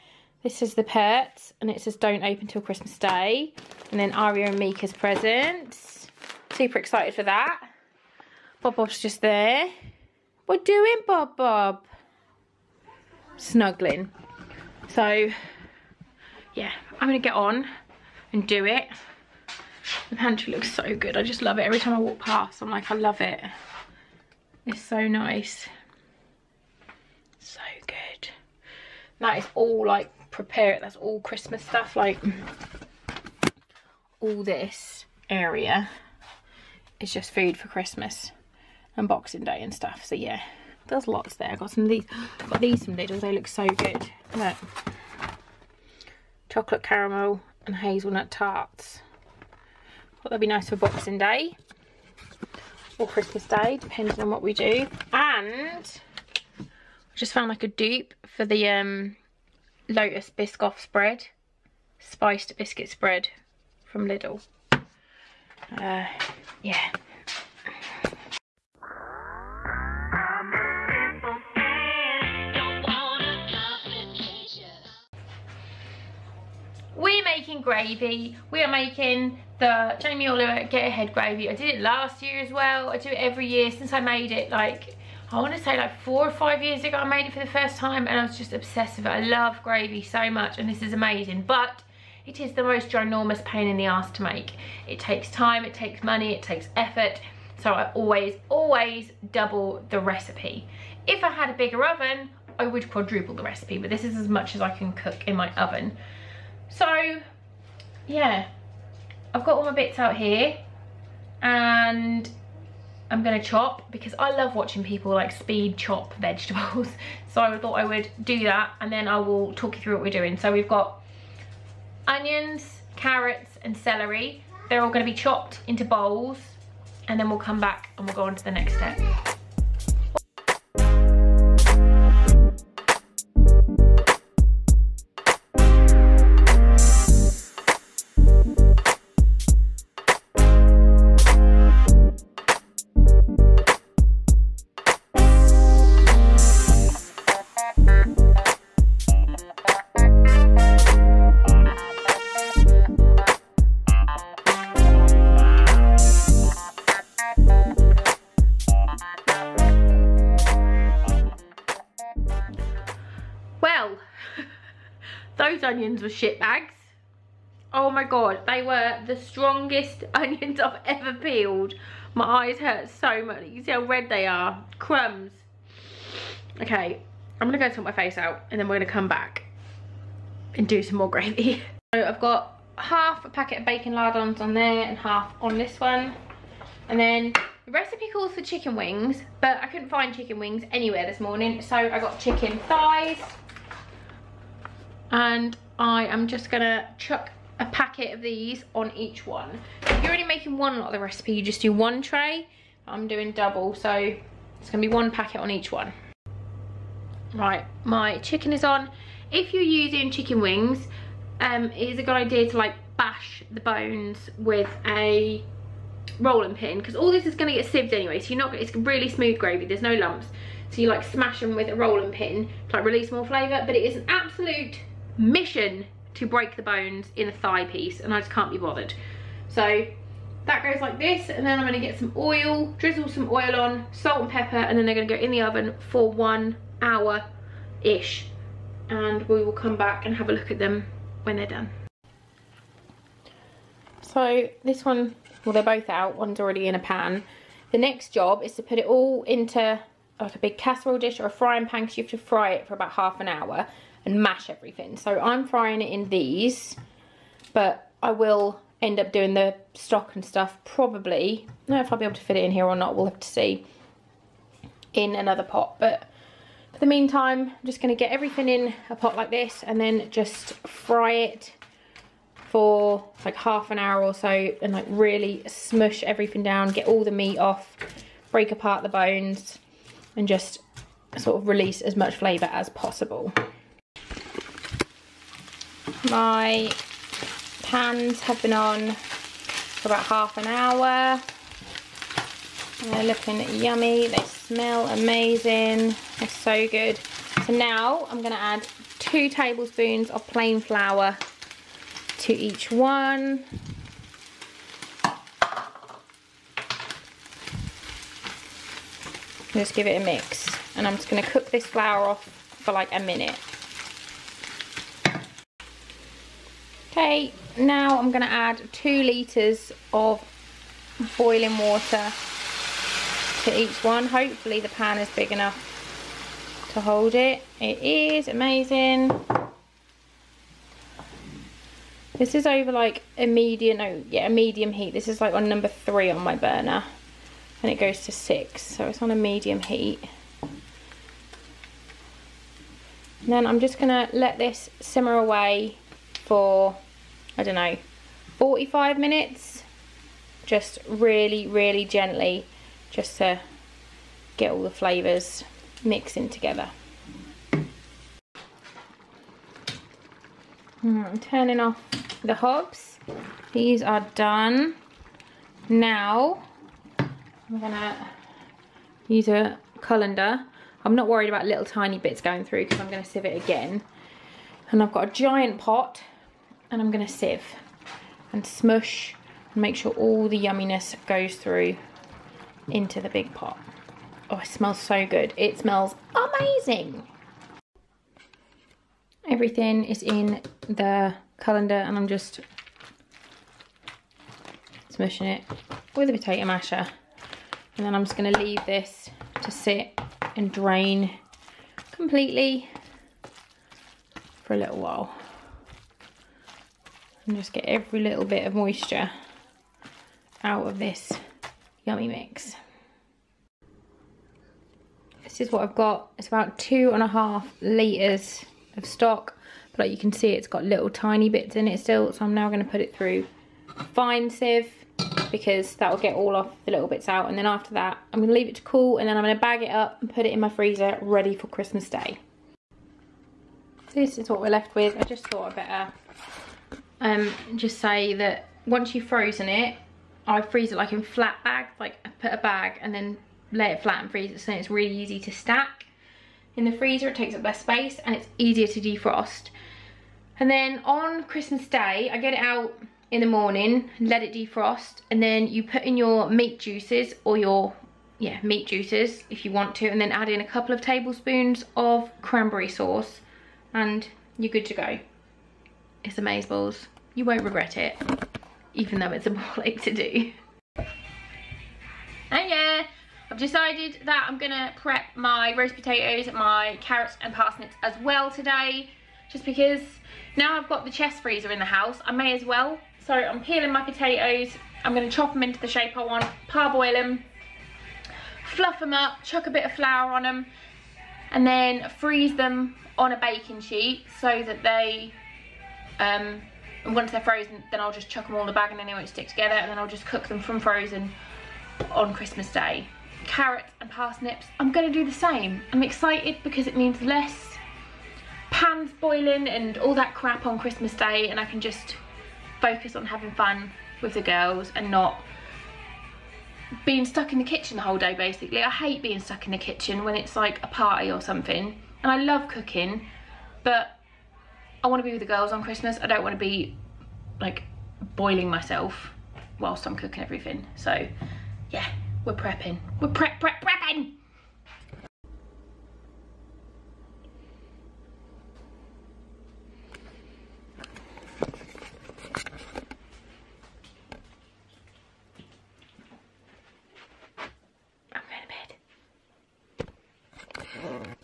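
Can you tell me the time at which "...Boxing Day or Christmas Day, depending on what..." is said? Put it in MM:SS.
00:50.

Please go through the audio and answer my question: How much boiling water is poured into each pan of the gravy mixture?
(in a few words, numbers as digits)
2 litres.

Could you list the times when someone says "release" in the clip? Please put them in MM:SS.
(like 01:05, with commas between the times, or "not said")
03:42, 04:41.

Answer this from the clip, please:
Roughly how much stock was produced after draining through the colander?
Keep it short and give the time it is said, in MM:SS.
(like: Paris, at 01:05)
2.5 litres, at 06:56.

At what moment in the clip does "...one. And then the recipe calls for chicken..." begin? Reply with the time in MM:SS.
03:05.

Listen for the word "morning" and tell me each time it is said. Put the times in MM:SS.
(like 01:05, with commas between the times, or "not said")
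03:11, 07:33.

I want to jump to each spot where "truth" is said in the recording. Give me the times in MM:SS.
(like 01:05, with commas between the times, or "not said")
not said.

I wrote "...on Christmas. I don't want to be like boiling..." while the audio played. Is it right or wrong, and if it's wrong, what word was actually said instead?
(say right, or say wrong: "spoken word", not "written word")
right.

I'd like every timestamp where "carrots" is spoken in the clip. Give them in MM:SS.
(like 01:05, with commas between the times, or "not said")
02:02, 07:56, 08:23.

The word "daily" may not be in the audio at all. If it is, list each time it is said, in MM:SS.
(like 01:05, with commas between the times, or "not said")
not said.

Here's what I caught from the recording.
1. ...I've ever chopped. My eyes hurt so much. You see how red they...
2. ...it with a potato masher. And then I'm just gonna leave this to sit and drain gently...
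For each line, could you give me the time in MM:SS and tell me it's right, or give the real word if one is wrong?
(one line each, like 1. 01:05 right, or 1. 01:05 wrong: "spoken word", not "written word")
1. 02:50 wrong: "peeled", not "chopped"
2. 06:35 wrong: "completely", not "gently".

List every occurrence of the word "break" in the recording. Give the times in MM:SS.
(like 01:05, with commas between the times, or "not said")
03:46, 04:38.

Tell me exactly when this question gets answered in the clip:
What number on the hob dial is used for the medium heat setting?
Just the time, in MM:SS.
05:35.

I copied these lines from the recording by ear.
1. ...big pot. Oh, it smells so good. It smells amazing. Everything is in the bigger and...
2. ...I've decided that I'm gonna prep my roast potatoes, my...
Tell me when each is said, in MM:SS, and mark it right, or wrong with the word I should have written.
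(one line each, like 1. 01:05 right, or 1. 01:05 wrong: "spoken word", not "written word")
1. 06:23 wrong: "colander", not "bigger"
2. 07:53 right.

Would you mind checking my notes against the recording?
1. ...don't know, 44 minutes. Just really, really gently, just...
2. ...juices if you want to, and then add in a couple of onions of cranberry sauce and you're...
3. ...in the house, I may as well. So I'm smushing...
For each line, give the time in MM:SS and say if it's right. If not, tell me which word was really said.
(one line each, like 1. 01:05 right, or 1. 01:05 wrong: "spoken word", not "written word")
1. 05:47 wrong: "45", not "44"
2. 07:38 wrong: "tablespoons", not "onions"
3. 08:01 wrong: "peeling", not "smushing".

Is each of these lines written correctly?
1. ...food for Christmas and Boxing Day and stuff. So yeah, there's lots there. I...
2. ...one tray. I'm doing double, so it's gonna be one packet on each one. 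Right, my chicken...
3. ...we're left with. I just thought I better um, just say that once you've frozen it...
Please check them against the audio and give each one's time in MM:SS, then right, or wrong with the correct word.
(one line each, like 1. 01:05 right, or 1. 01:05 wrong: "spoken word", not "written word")
1. 00:37 right
2. 03:21 right
3. 07:14 right.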